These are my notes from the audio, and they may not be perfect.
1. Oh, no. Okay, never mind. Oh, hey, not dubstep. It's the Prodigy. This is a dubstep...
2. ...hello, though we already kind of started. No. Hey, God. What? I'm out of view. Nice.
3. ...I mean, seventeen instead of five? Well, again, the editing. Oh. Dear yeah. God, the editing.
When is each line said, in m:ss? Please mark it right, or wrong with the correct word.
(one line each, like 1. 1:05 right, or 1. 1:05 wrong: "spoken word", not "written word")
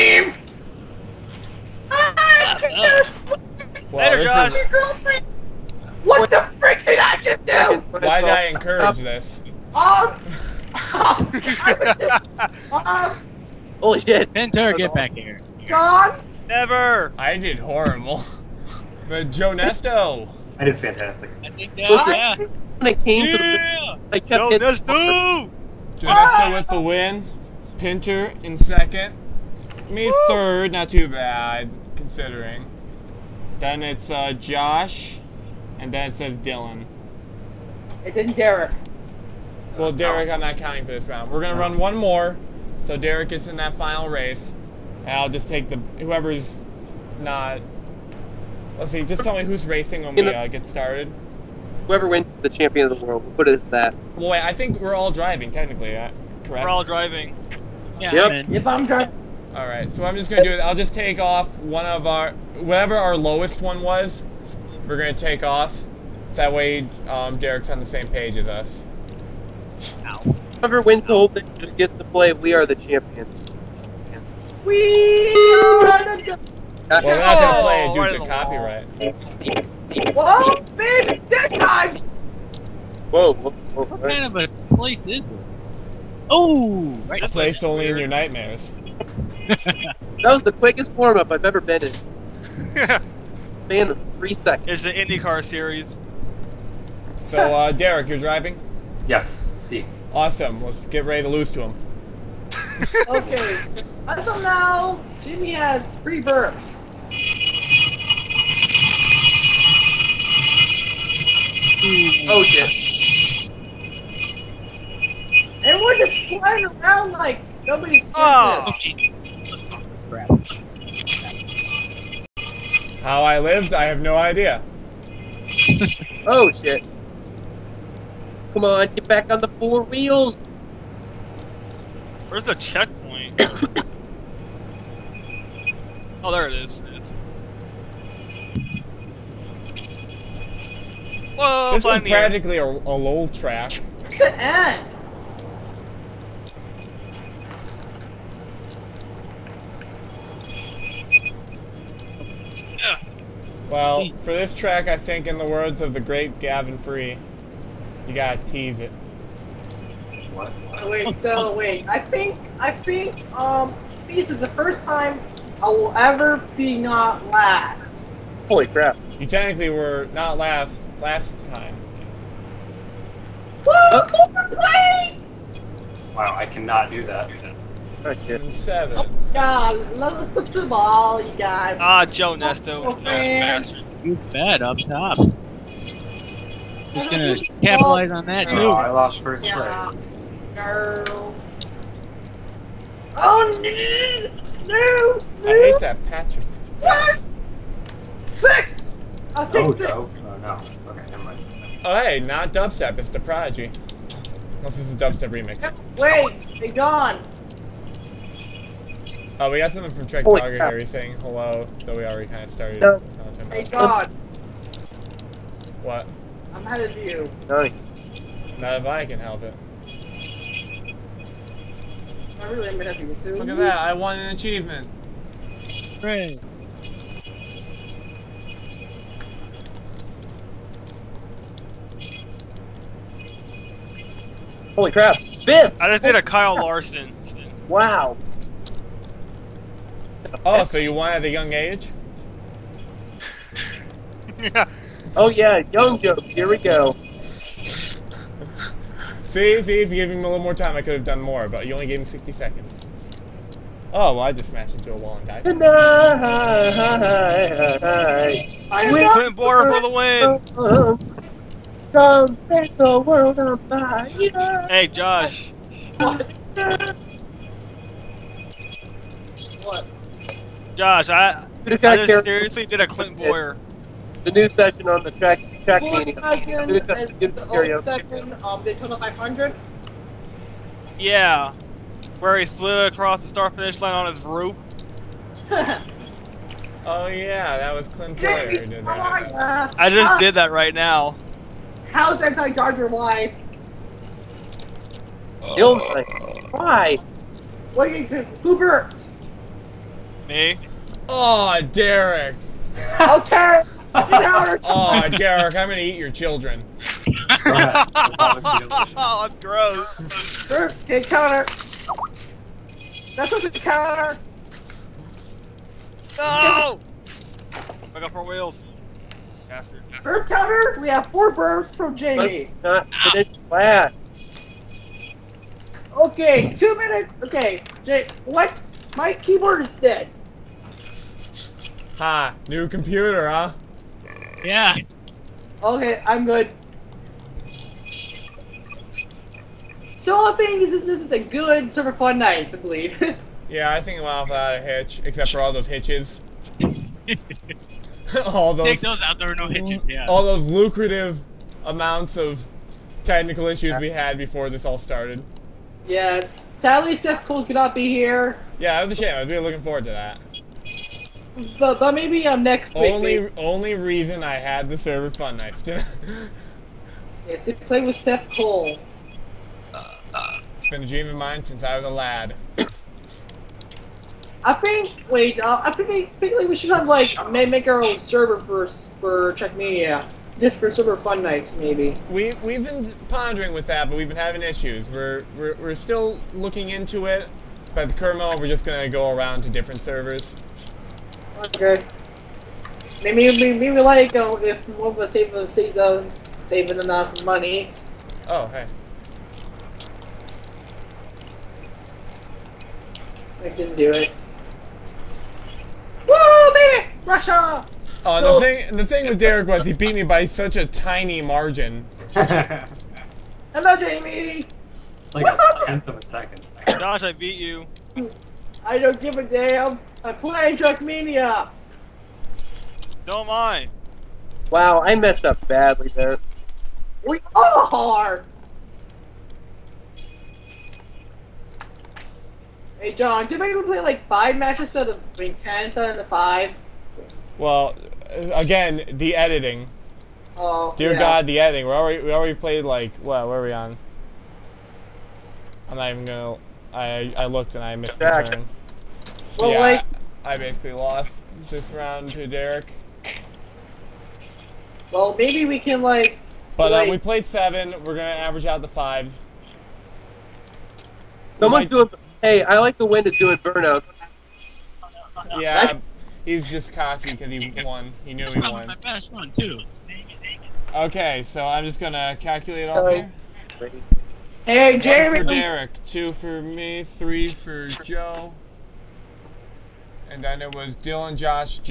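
1. 3:20 right
2. 3:31 right
3. 7:15 wrong: "ten", not "seventeen".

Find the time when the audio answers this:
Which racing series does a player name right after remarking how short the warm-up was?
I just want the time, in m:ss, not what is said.
1:34.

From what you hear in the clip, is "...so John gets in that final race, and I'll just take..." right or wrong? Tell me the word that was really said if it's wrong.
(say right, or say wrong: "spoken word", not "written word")
wrong: "Derek", not "John".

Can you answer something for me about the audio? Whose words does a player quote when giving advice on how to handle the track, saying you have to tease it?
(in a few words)
Gavin Free.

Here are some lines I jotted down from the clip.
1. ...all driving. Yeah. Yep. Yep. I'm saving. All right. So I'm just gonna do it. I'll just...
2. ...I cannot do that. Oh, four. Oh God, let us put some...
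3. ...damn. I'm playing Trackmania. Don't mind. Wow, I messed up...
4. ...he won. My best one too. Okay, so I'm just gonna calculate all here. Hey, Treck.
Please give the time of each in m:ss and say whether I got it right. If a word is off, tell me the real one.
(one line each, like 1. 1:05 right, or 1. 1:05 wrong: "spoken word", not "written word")
1. 0:56 wrong: "driving", not "saving"
2. 2:56 wrong: "seven", not "four"
3. 6:59 right
4. 7:48 wrong: "Jaime", not "Treck".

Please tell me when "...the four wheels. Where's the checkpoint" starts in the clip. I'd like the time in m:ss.
2:09.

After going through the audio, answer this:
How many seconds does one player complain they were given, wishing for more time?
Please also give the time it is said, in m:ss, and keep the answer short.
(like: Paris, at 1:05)
60, at 4:12.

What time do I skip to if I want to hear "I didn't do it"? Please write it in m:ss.
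6:43.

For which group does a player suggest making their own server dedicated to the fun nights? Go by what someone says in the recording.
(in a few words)
Czech Media.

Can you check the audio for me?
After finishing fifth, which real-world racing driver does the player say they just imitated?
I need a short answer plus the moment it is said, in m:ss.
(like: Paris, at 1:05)
Kyle Larson, at 3:56.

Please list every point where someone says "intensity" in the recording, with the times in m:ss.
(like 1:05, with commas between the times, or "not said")
not said.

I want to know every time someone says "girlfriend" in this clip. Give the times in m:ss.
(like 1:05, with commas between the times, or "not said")
0:04.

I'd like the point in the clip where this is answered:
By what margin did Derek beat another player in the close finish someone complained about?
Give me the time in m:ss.
6:55.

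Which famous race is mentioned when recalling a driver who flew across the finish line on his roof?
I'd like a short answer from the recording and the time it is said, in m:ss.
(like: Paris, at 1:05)
Daytona 500, at 4:38.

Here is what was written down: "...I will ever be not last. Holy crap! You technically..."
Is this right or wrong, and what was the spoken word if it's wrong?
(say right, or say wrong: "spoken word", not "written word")
right.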